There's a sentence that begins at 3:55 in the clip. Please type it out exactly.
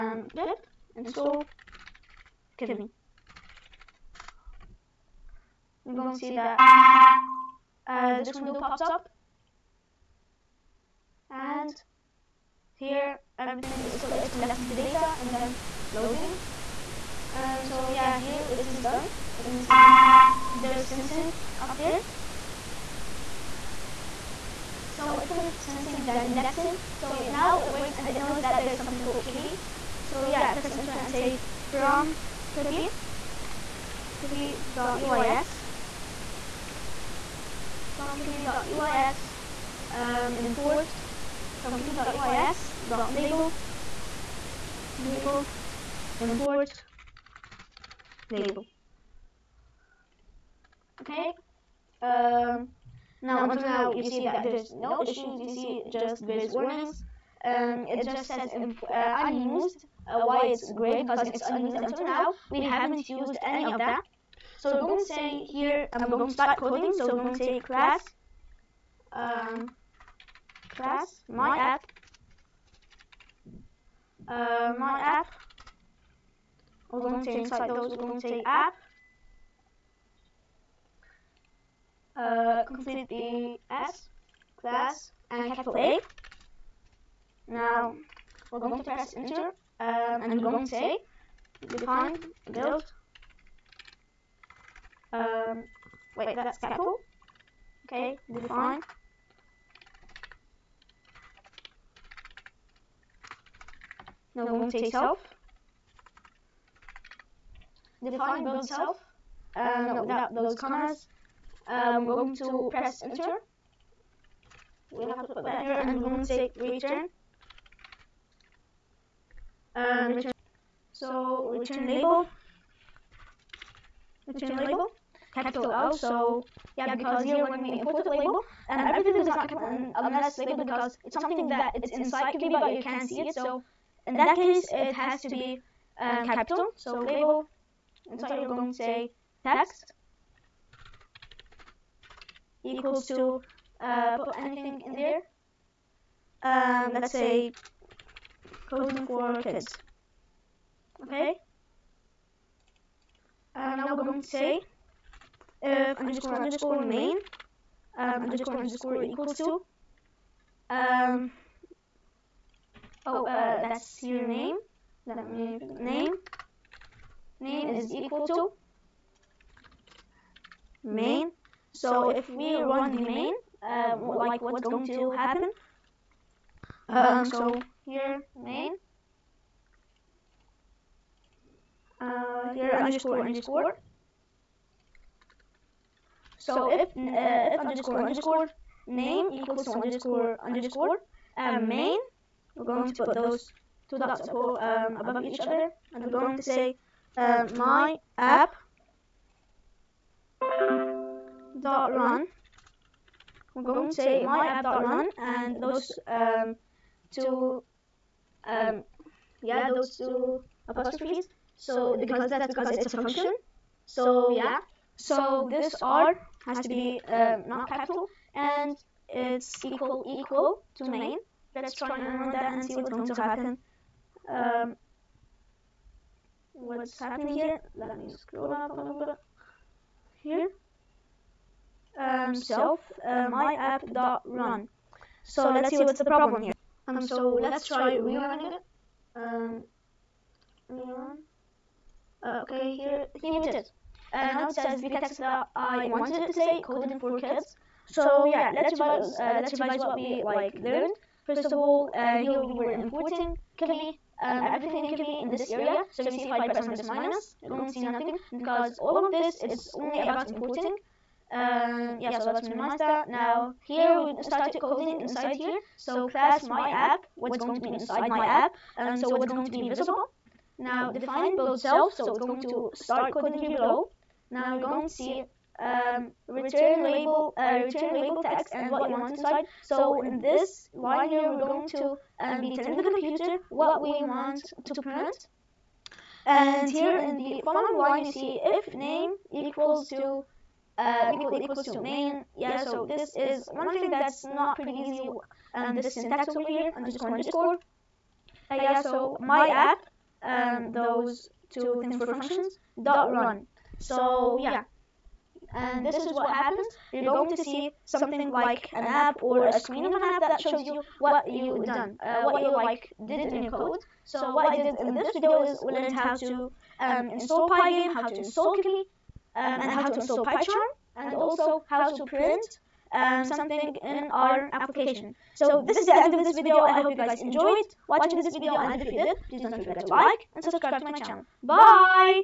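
So, so let's, let's see what's the problem here.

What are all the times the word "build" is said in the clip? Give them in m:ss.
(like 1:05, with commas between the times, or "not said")
1:32, 1:48, 4:31.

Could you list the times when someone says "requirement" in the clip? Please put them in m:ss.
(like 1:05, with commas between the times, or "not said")
not said.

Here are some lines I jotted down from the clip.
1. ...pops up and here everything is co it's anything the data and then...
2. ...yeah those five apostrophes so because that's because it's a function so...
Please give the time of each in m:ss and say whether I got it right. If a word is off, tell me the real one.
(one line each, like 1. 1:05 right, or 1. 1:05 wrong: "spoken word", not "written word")
1. 0:08 wrong: "collecting", not "anything"
2. 3:29 wrong: "two", not "five".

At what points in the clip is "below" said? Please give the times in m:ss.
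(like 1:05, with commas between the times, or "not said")
4:33.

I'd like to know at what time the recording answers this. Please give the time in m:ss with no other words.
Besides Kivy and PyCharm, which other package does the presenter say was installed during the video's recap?
5:17.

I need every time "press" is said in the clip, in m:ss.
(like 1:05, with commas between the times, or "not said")
0:30, 1:28, 1:52, 4:16.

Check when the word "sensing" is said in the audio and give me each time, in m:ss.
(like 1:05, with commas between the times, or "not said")
0:20, 0:25.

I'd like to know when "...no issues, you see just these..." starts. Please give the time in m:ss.
0:54.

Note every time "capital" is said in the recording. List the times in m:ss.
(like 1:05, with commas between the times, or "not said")
1:25, 1:36, 2:05, 2:09, 2:16, 3:37.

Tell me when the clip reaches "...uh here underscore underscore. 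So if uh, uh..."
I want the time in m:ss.
3:02.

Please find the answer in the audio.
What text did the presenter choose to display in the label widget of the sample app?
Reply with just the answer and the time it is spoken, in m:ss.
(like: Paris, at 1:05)
Coding for kids, at 2:28.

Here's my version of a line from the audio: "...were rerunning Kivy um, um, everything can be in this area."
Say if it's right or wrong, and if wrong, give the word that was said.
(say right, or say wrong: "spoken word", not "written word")
wrong: "importing", not "rerunning".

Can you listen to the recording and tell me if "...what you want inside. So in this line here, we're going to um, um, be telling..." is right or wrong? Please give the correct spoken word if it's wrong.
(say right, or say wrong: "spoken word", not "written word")
right.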